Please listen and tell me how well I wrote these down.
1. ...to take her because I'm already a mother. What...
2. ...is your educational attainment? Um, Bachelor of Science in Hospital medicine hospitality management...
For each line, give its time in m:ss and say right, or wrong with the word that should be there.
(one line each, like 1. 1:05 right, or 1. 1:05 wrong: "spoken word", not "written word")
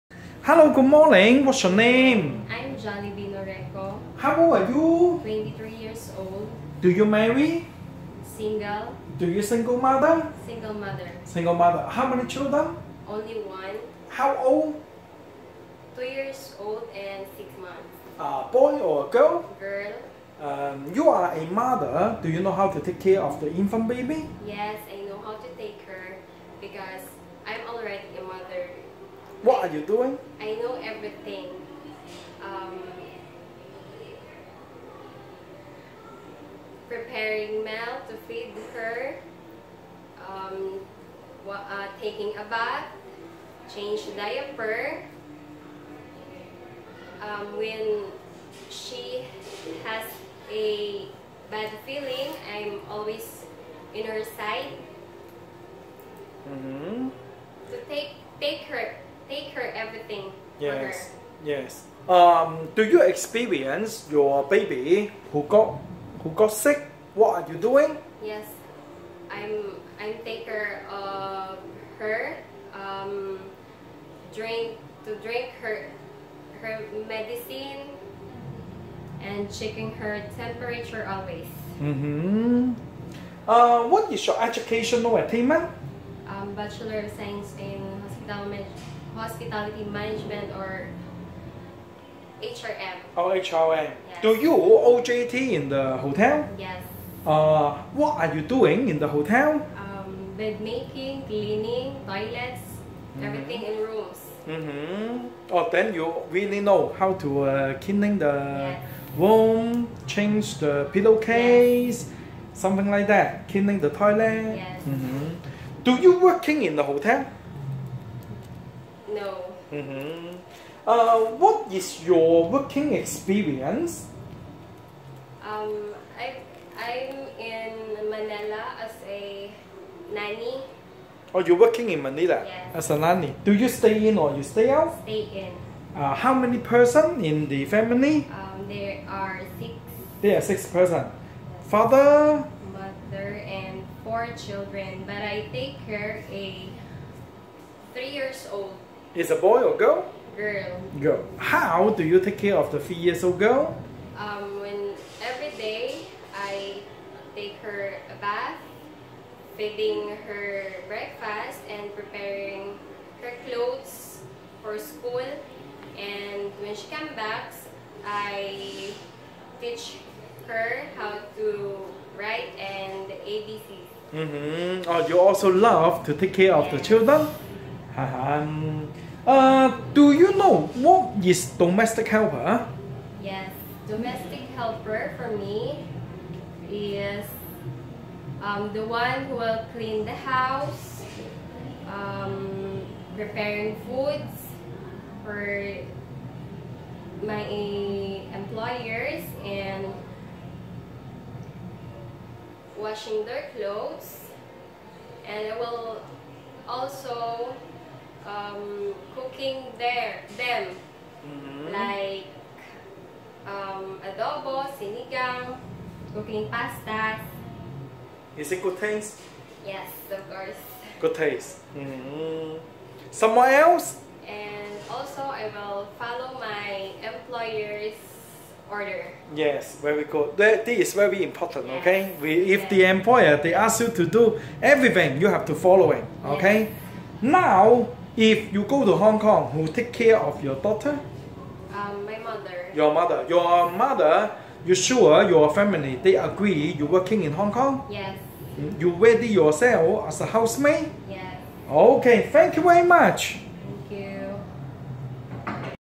1. 0:25 right
2. 1:24 right.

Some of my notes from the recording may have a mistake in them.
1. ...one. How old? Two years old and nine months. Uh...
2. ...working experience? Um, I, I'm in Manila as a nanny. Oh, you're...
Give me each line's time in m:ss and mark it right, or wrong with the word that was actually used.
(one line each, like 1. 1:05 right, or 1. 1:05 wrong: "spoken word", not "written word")
1. 0:13 wrong: "six", not "nine"
2. 2:02 right.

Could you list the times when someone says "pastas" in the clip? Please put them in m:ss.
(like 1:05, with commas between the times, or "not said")
3:36.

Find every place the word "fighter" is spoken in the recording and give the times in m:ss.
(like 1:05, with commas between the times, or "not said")
not said.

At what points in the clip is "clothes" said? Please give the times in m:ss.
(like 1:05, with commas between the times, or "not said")
2:43, 3:23.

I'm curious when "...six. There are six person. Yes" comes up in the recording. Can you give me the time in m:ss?
2:19.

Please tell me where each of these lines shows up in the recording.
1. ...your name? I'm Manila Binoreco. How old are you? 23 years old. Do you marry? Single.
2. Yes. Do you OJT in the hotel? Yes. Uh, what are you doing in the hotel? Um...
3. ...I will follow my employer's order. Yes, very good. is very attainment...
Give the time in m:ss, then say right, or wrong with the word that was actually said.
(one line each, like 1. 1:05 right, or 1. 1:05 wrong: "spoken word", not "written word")
1. 0:01 wrong: "Johnny", not "Manila"
2. 1:34 right
3. 3:45 wrong: "important", not "attainment".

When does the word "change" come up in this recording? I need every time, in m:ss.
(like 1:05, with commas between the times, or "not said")
0:43, 1:50.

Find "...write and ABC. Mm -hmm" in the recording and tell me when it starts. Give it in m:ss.
2:52.